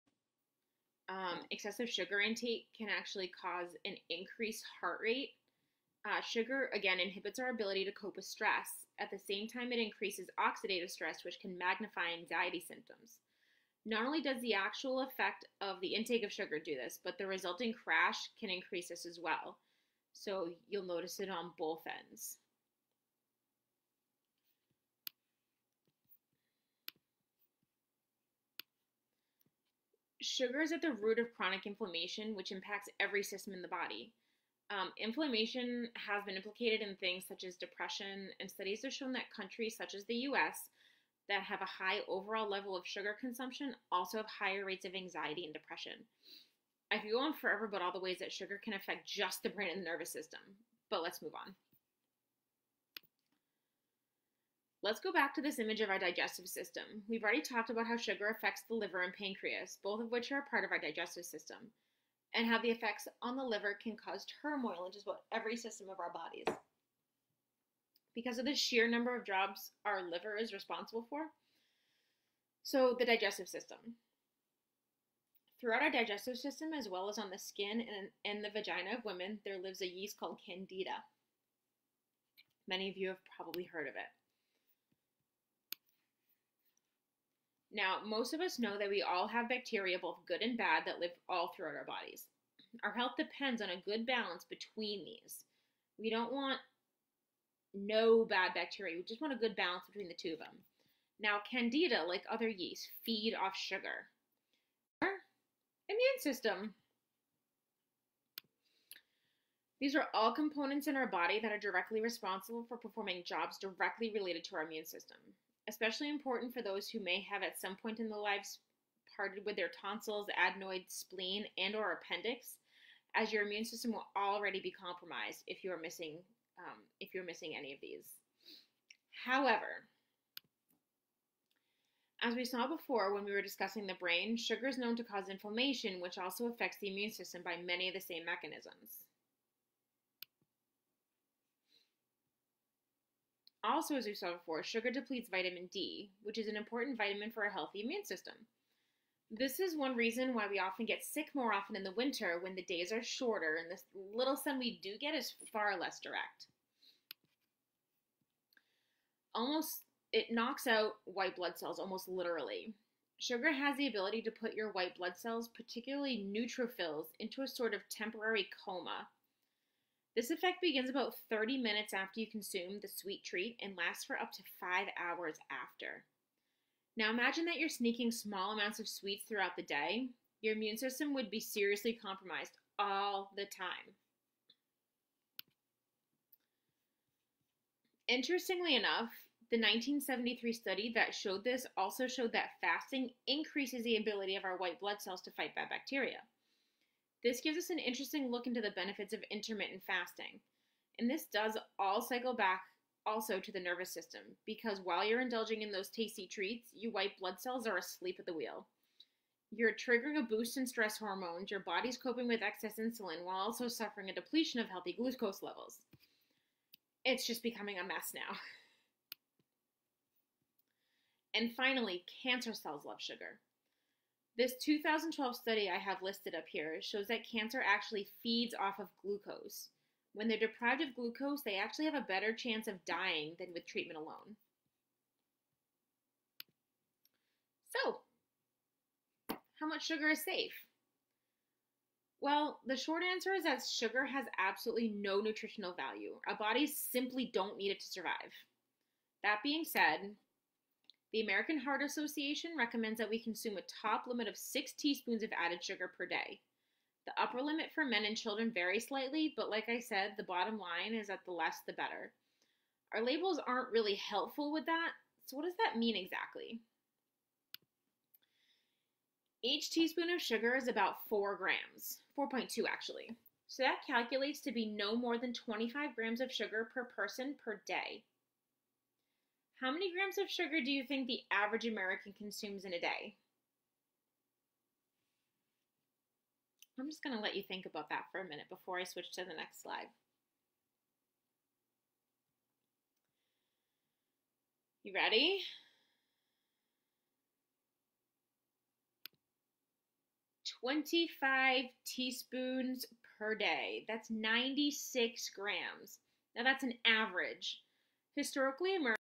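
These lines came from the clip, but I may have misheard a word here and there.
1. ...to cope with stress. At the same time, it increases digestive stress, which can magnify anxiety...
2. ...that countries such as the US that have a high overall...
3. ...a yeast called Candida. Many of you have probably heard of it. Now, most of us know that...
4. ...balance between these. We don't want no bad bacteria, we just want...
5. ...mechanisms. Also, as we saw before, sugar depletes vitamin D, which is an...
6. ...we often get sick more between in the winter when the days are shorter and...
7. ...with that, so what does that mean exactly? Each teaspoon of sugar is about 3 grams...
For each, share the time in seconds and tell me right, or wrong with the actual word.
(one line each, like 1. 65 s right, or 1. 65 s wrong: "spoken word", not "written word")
1. 7 s wrong: "oxidative", not "digestive"
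2. 39 s right
3. 79 s right
4. 94 s right
5. 138 s right
6. 150 s wrong: "often", not "between"
7. 264 s wrong: "4", not "3".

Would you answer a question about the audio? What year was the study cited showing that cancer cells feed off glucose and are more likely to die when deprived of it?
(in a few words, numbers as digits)
2012.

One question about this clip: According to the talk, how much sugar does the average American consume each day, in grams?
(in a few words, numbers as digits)
96 grams.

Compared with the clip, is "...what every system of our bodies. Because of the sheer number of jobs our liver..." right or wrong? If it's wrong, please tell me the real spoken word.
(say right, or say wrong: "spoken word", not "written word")
right.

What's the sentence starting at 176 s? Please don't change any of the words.
Now imagine that you're sneaking small amounts of sweets throughout the day.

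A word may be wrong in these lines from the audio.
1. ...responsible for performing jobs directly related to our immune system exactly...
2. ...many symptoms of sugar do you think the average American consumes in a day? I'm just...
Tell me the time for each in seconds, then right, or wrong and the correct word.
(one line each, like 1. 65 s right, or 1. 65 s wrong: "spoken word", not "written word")
1. 112 s wrong: "especially", not "exactly"
2. 279 s wrong: "grams", not "symptoms".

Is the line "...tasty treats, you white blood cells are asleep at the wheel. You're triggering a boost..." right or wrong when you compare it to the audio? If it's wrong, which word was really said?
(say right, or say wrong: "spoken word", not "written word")
right.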